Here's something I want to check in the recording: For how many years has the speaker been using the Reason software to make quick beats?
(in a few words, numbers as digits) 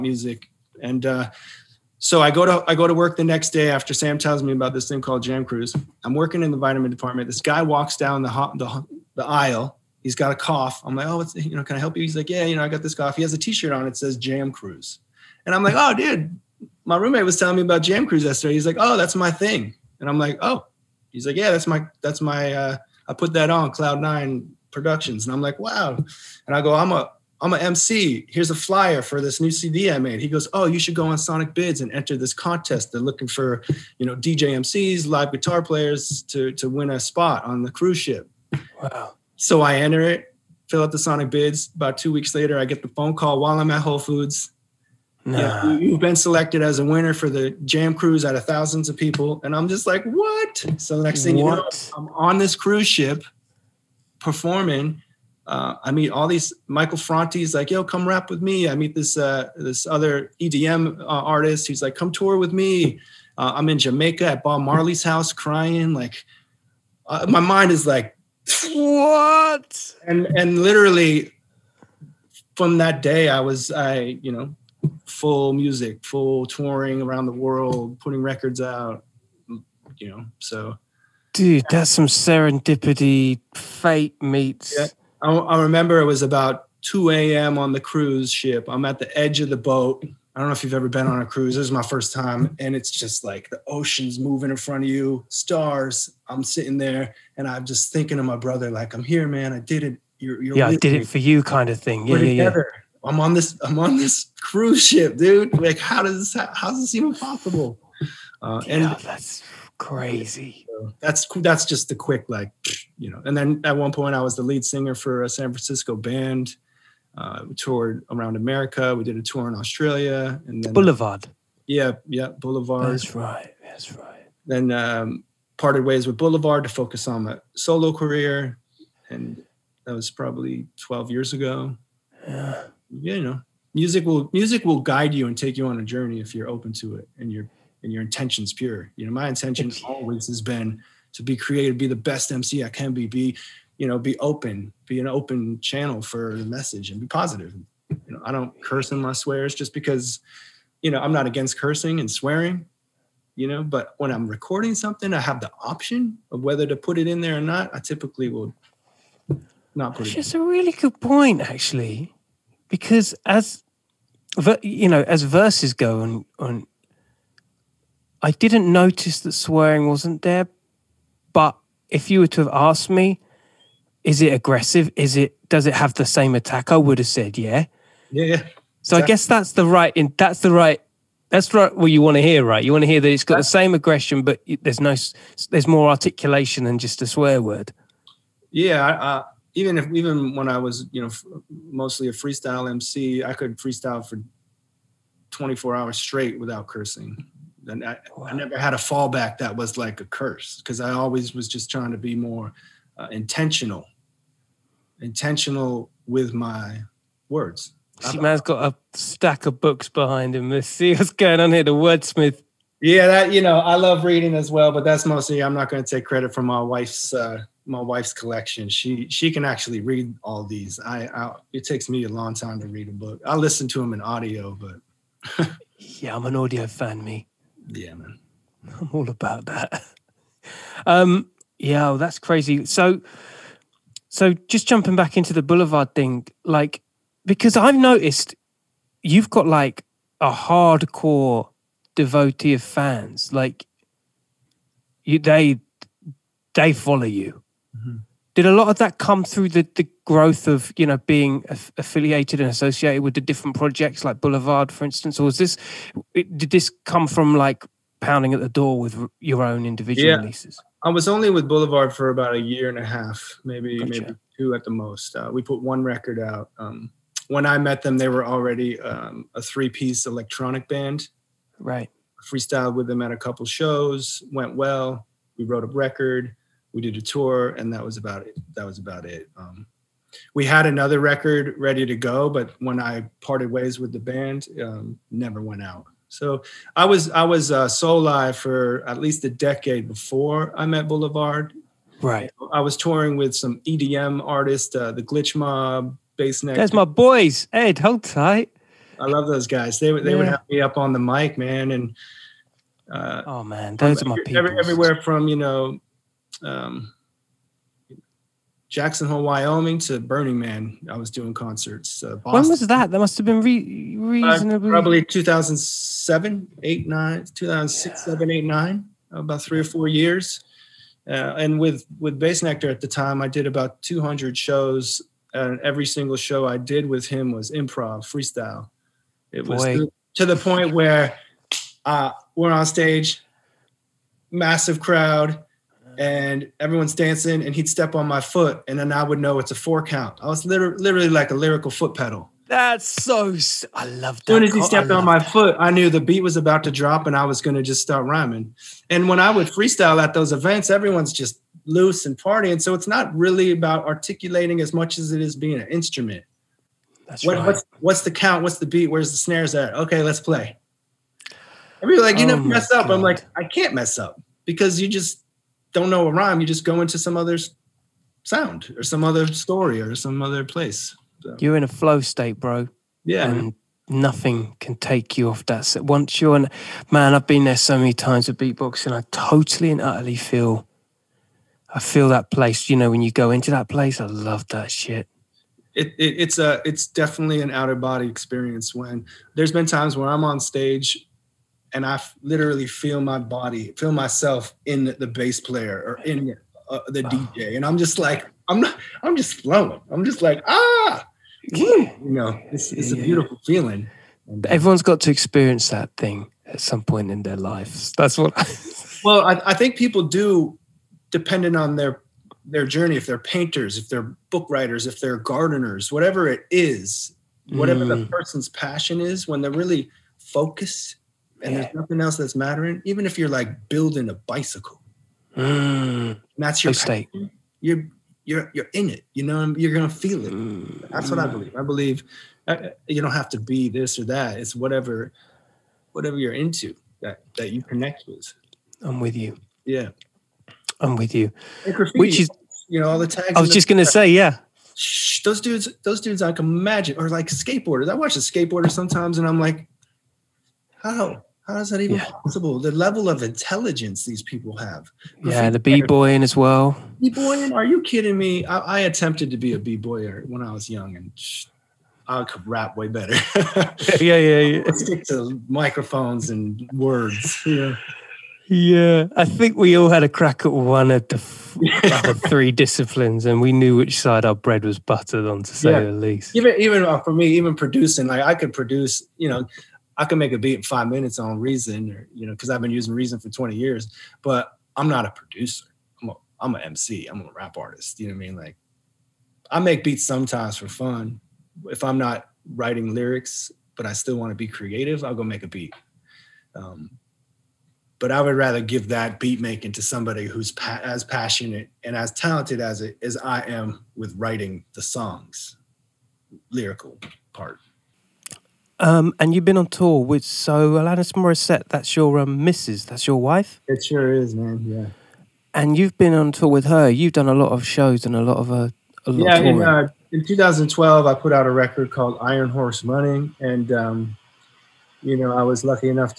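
20 years.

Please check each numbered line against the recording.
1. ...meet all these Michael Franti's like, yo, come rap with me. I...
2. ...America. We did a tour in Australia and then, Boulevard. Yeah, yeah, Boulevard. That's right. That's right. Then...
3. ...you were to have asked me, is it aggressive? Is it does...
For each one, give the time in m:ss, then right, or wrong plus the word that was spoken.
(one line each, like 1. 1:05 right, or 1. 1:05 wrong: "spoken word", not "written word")
1. 0:55 right
2. 1:58 right
3. 2:52 right.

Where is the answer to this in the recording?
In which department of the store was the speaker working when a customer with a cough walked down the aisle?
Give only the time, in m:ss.
0:06.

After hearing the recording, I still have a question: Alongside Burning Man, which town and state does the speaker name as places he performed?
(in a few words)
Jackson Hole, Wyoming.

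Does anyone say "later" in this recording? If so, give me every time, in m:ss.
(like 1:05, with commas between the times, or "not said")
0:42.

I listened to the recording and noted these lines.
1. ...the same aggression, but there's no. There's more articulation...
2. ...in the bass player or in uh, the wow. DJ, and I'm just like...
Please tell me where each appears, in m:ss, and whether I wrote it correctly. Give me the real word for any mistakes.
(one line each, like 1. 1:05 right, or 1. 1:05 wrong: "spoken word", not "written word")
1. 3:03 right
2. 6:34 right.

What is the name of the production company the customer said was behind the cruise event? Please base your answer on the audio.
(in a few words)
Cloud Nine Productions.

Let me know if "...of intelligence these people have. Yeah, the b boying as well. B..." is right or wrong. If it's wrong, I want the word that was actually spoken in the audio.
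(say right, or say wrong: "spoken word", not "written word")
right.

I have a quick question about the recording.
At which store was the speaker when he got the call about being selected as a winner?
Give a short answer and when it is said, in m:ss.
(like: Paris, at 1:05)
Whole Foods, at 0:43.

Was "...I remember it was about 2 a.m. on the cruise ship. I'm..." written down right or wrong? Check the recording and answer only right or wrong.
right.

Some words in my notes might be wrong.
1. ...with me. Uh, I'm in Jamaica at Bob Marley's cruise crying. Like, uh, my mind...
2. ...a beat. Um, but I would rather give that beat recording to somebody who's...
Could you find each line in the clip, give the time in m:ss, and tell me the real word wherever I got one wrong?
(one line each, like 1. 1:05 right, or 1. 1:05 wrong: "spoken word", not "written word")
1. 1:02 wrong: "house", not "cruise"
2. 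8:15 wrong: "making", not "recording".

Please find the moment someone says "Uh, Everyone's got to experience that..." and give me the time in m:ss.
6:44.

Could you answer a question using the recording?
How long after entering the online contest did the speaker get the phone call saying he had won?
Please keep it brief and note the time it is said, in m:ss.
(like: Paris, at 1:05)
2 weeks, at 0:41.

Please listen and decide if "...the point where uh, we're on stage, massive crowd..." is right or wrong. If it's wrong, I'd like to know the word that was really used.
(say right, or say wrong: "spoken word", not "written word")
right.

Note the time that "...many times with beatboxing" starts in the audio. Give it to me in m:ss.
6:17.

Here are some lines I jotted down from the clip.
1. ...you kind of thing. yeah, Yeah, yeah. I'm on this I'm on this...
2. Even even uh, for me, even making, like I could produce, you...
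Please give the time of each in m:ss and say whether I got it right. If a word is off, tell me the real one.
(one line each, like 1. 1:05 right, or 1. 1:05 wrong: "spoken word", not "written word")
1. 1:41 right
2. 7:56 wrong: "producing", not "making".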